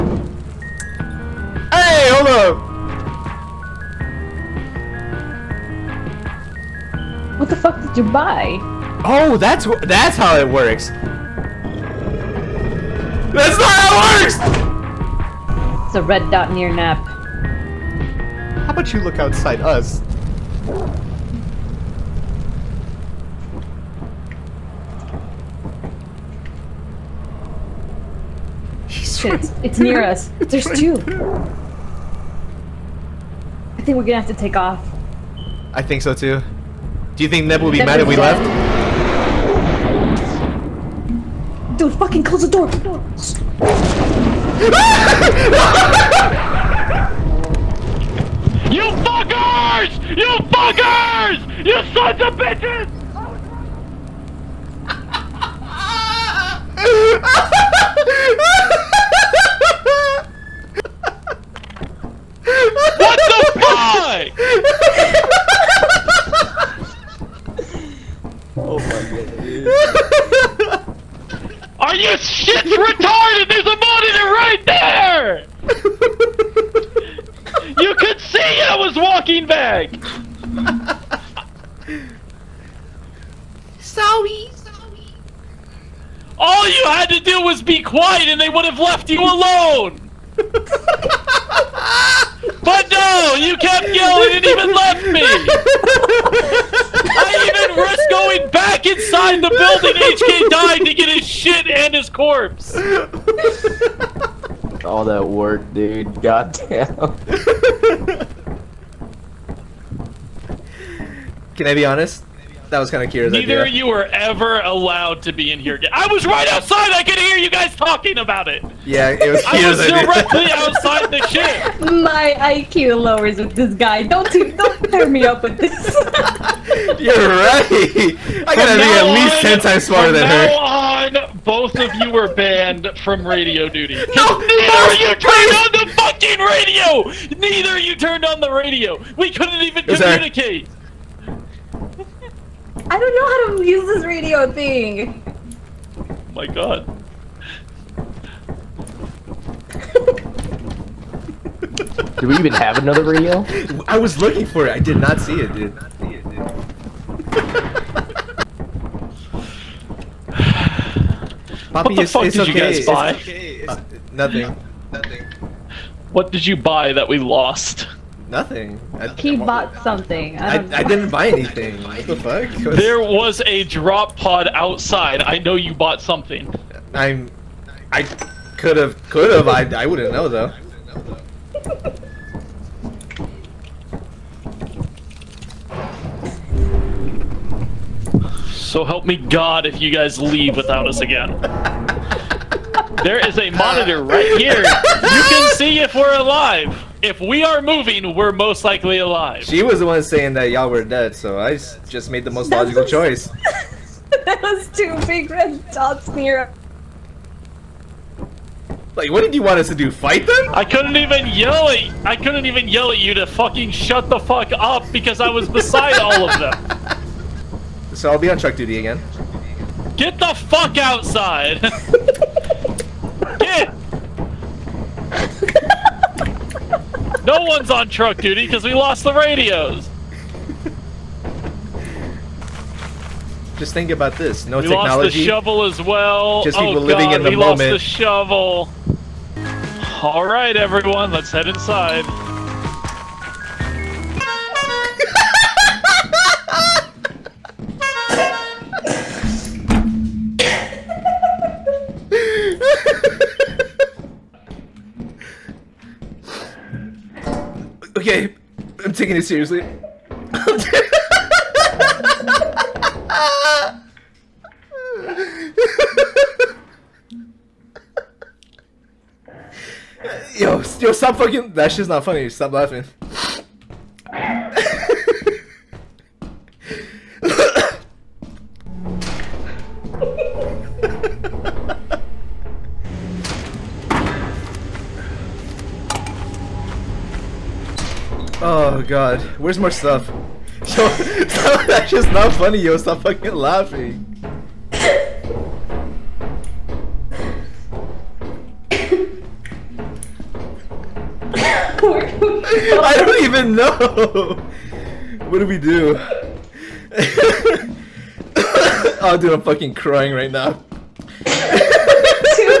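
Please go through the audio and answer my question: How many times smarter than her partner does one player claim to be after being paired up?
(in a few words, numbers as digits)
10.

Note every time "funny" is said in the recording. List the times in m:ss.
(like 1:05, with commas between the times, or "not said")
4:32, 4:52.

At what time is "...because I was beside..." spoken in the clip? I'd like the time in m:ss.
3:34.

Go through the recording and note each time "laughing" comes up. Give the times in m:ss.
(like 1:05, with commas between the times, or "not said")
4:32, 4:53.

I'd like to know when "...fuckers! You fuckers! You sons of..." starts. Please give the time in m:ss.
0:49.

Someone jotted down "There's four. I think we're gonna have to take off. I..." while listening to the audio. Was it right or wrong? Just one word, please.
wrong.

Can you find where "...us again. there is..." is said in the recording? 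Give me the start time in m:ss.
3:10.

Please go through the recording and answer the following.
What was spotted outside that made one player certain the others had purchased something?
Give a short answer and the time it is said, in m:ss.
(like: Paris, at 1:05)
a drop pod, at 2:53.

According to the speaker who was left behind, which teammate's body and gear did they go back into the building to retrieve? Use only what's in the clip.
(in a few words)
HK.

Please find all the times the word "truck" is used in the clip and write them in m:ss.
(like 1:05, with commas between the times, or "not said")
3:38, 3:47.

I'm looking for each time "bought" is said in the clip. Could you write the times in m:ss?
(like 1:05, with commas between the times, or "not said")
2:49, 2:55.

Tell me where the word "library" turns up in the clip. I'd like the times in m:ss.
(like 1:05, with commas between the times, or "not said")
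not said.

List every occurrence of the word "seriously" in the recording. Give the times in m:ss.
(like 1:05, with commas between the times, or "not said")
4:19.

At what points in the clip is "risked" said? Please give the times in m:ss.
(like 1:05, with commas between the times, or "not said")
1:37.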